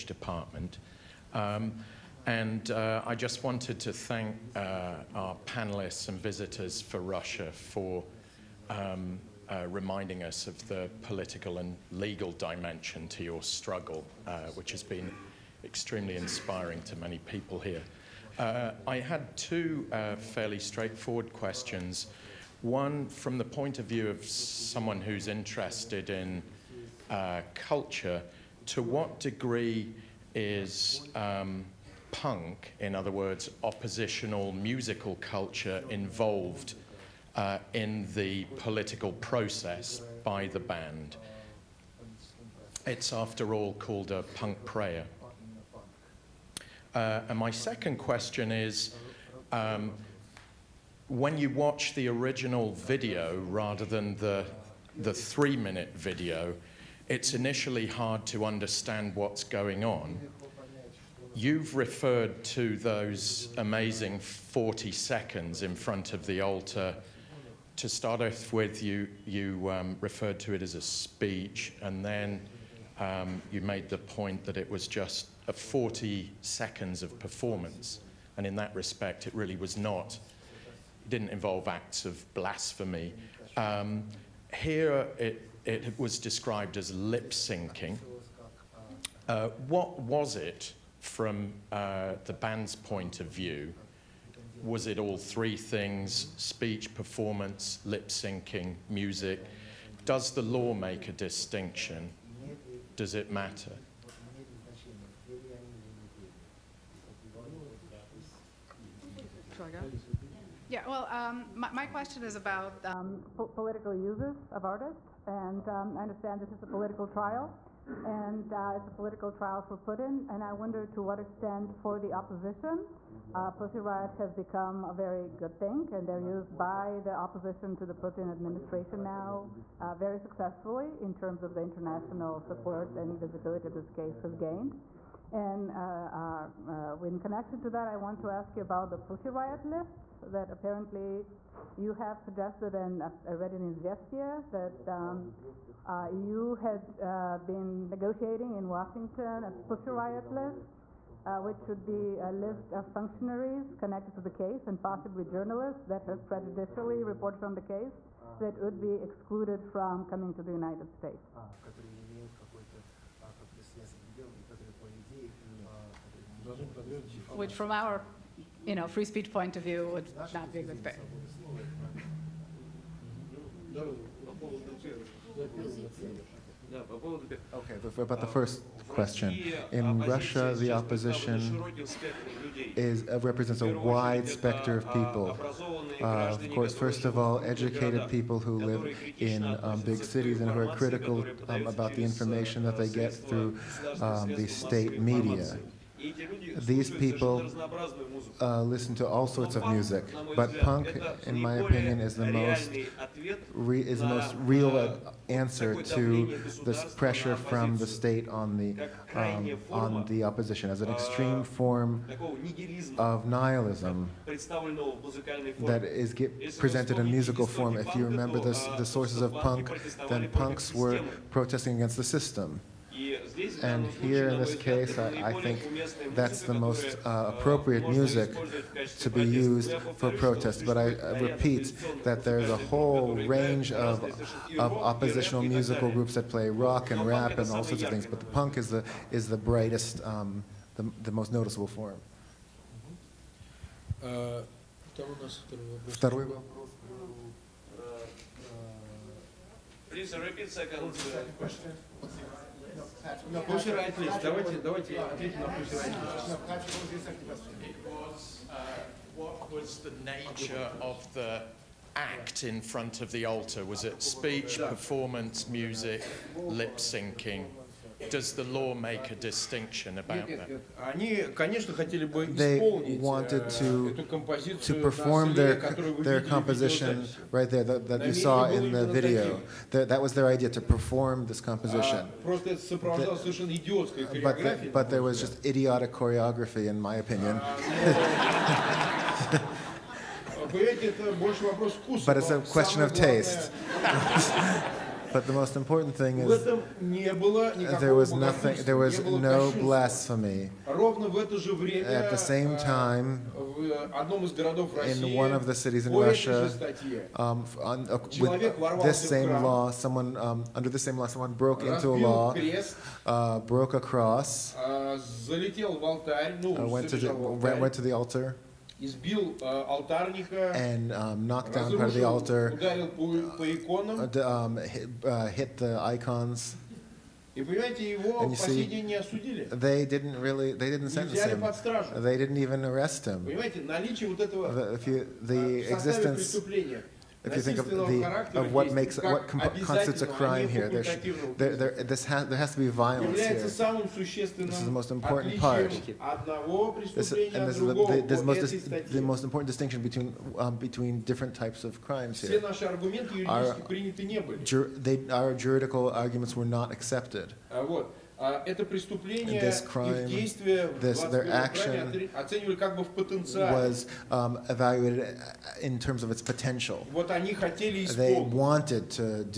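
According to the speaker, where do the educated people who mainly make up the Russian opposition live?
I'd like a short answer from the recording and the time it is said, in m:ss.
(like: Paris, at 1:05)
big cities, at 3:09.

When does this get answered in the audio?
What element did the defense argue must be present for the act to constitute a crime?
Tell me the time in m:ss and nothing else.
5:42.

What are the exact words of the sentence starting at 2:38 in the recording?
that would be excluded from coming to the United States.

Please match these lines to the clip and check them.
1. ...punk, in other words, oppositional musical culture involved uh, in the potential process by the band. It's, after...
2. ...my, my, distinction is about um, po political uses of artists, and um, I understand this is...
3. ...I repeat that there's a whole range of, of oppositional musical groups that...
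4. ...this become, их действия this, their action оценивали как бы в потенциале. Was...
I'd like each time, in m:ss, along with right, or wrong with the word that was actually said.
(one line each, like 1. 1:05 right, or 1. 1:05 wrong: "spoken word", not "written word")
1. 0:32 wrong: "political", not "potential"
2. 1:51 wrong: "question", not "distinction"
3. 3:50 right
4. 5:59 wrong: "crime", not "become".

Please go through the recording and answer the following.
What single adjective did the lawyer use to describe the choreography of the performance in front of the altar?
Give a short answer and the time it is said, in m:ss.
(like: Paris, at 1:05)
idiotic, at 4:45.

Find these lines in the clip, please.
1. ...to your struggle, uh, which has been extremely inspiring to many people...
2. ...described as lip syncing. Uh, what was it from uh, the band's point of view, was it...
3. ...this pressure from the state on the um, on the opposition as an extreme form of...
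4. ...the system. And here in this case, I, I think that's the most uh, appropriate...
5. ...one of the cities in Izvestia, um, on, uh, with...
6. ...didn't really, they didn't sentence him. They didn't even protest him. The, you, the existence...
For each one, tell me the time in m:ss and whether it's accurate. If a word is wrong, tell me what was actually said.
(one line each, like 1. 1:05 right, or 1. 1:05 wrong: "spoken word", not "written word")
1. 0:13 right
2. 1:26 right
3. 3:26 right
4. 3:41 right
5. 5:05 wrong: "Russia", not "Izvestia"
6. 5:29 wrong: "arrest", not "protest".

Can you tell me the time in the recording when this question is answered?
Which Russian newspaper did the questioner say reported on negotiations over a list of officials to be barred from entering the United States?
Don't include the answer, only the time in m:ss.
2:23.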